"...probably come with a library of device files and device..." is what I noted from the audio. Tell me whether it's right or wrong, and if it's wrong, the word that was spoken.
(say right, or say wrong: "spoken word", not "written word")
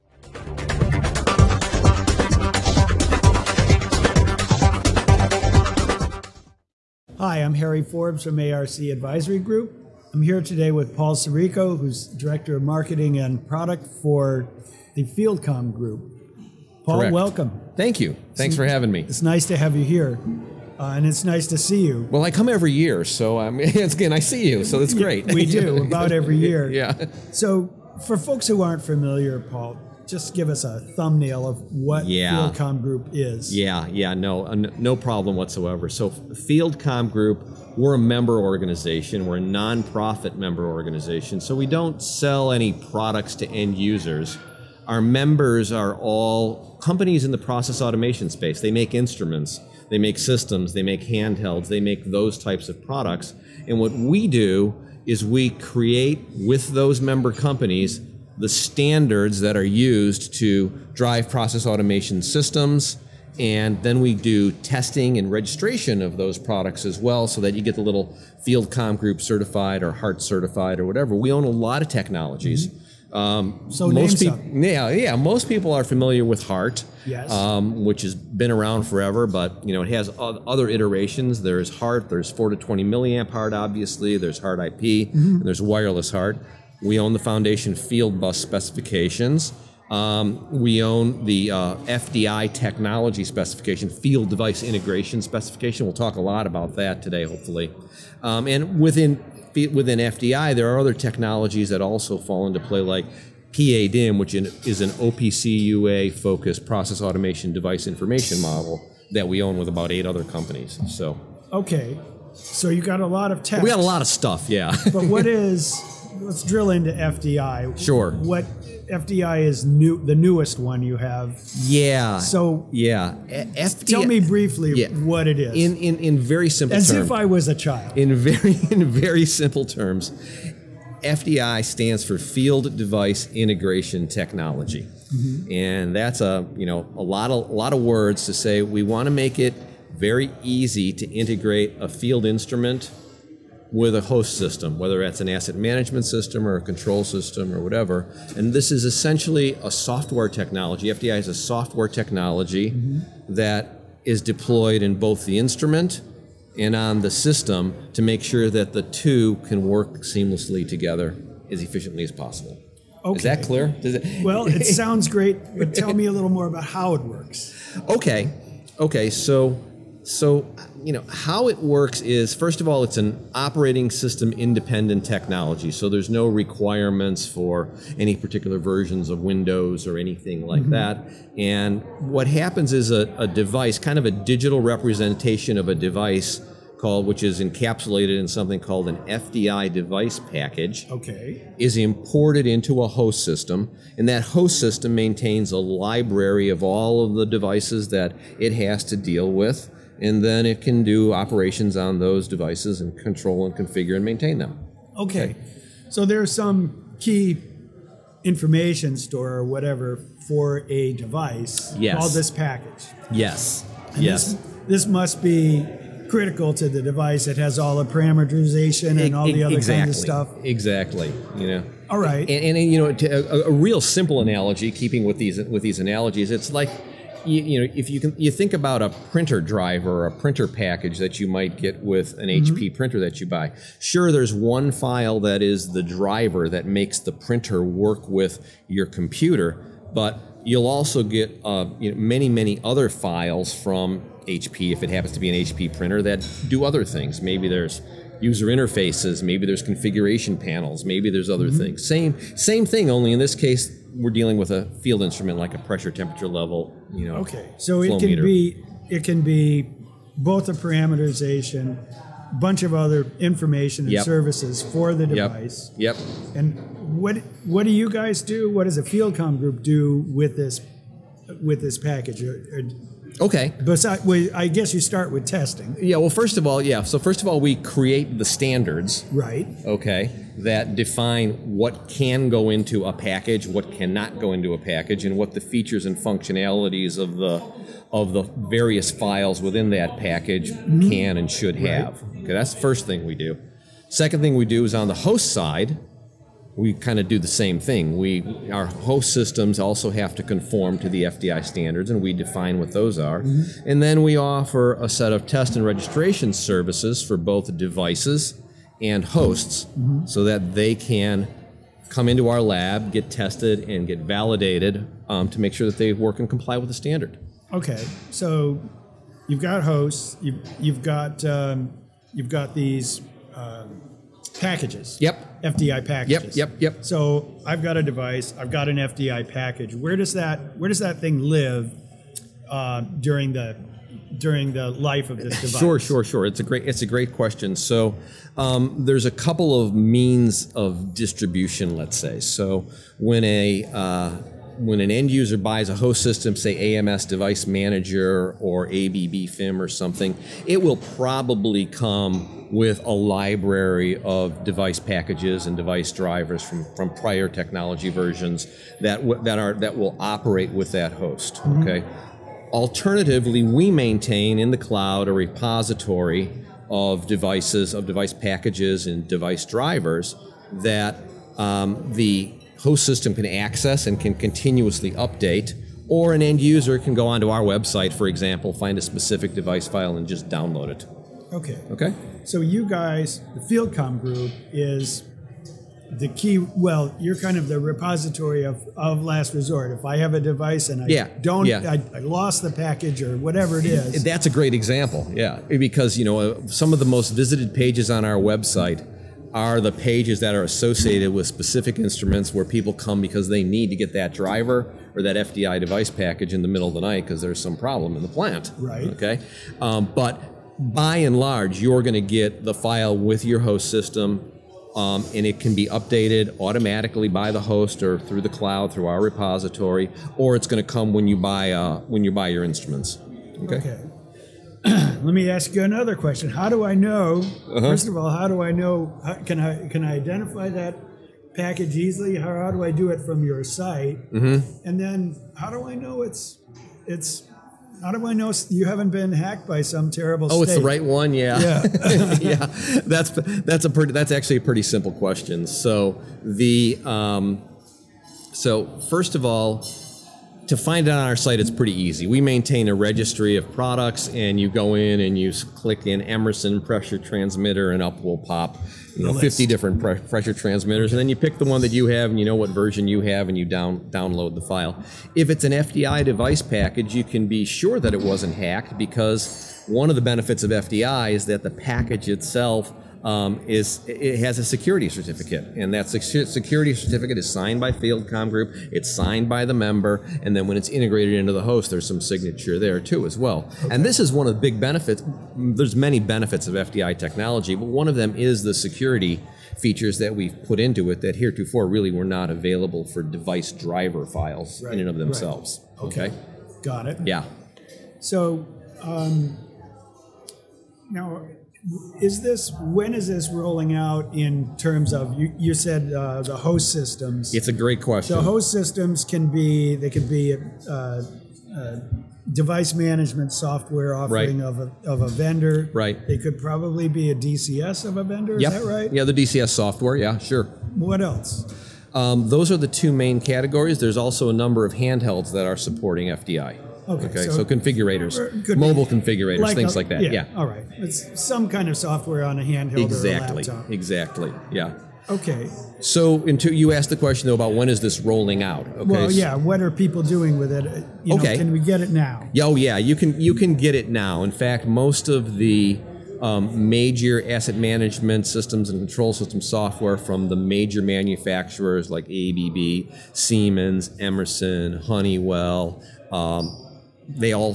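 wrong: "packages", not "files".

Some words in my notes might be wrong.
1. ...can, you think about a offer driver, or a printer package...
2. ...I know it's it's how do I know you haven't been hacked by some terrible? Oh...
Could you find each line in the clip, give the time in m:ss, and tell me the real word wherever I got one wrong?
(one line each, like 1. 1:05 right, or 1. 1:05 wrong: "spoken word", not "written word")
1. 3:47 wrong: "printer", not "offer"
2. 7:15 right.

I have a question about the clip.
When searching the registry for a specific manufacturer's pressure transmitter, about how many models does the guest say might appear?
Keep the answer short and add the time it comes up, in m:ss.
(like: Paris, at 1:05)
50, at 7:39.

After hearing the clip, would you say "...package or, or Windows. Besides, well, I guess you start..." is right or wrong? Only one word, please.
wrong.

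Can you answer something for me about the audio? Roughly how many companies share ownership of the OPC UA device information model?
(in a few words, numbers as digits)
8.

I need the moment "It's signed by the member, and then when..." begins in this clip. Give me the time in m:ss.
7:58.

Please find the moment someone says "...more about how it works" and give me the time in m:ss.
2:46.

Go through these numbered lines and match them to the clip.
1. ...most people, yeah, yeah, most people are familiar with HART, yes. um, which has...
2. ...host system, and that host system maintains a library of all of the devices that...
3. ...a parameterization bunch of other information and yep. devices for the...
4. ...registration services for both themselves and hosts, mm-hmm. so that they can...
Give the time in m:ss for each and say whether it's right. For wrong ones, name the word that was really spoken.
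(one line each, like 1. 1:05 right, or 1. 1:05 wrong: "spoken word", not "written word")
1. 1:13 right
2. 3:12 right
3. 4:20 wrong: "services", not "devices"
4. 5:05 wrong: "devices", not "themselves".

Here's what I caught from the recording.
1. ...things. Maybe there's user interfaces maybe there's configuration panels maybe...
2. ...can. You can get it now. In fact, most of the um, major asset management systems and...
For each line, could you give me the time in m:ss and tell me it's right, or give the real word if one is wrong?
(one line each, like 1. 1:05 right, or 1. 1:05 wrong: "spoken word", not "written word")
1. 4:06 right
2. 9:02 right.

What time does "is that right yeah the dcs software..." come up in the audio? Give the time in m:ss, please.
8:38.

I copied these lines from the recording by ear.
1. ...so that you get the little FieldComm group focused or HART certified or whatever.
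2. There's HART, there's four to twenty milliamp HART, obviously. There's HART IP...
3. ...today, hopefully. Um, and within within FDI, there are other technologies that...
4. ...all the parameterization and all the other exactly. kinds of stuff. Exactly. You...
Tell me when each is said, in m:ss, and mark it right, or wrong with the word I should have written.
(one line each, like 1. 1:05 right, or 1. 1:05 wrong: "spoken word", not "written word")
1. 1:07 wrong: "certified", not "focused"
2. 1:21 right
3. 1:37 right
4. 3:37 right.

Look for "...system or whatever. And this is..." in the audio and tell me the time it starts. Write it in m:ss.
2:27.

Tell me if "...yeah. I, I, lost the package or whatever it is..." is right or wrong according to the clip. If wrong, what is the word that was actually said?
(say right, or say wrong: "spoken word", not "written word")
right.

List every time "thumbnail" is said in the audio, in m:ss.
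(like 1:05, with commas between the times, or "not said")
0:30.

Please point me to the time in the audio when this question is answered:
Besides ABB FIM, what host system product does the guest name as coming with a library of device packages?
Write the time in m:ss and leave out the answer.
5:46.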